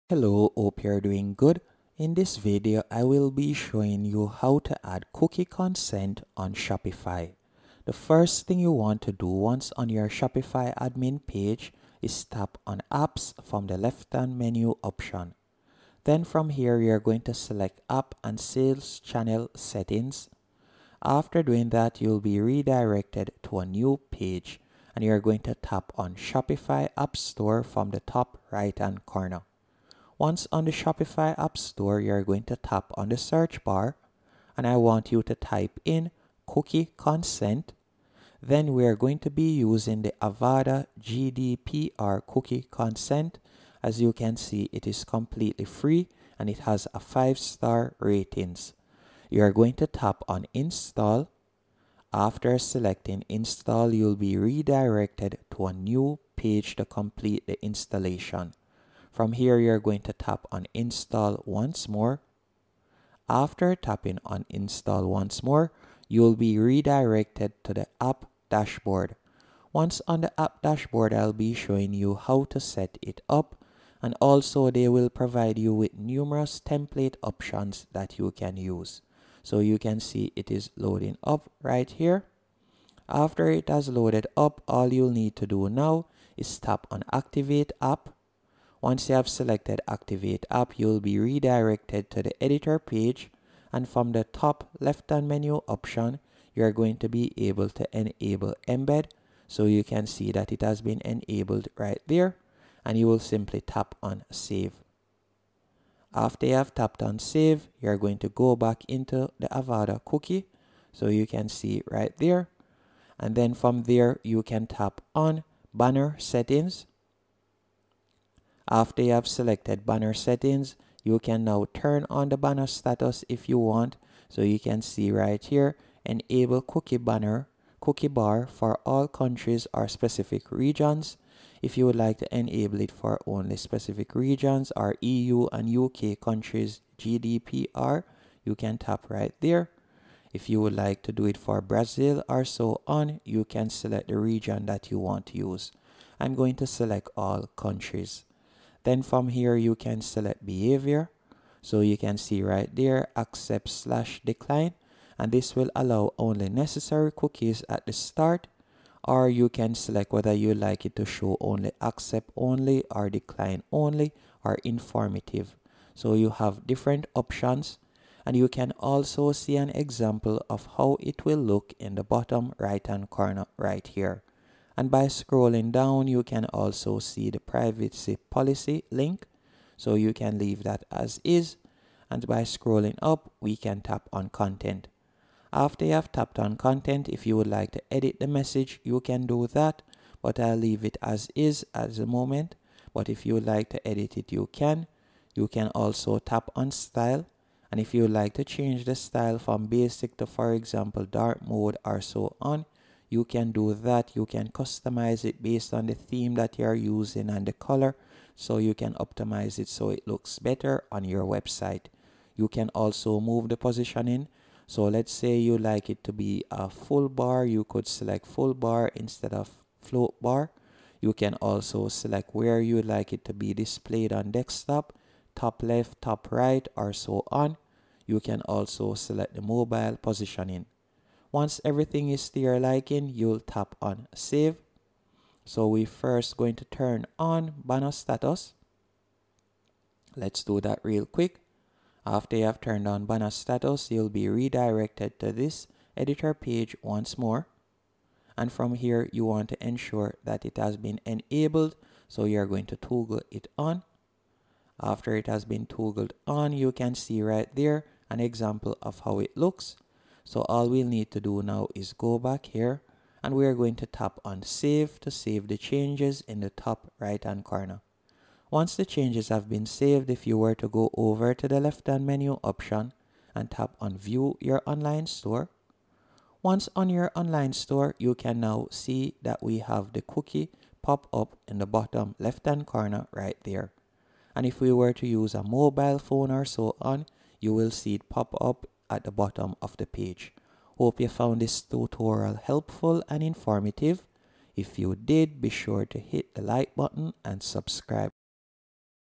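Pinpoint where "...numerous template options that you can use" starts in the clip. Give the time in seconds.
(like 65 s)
75 s.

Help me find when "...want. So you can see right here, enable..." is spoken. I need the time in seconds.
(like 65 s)
123 s.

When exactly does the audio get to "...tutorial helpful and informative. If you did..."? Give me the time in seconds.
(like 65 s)
291 s.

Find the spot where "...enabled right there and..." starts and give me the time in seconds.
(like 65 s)
101 s.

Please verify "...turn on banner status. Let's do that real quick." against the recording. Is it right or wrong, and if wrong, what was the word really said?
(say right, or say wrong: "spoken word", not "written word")
right.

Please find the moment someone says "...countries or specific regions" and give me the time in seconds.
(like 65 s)
129 s.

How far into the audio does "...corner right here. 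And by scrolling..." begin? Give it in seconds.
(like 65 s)
173 s.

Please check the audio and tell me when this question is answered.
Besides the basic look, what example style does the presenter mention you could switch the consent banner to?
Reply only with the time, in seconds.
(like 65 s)
201 s.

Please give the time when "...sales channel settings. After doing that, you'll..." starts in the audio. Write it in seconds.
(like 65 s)
18 s.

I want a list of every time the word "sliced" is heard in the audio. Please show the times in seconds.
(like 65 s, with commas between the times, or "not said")
not said.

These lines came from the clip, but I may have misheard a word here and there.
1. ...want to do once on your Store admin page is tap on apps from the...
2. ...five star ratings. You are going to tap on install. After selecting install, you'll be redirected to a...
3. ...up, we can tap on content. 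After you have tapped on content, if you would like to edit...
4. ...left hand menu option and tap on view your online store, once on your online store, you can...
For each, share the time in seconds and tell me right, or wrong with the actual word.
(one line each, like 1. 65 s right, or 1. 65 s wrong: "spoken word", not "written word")
1. 8 s wrong: "Shopify", not "Store"
2. 46 s right
3. 182 s right
4. 271 s right.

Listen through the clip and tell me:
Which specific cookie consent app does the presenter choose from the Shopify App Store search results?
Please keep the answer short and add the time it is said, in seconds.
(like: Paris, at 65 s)
Avada GDPR cookie consent, at 40 s.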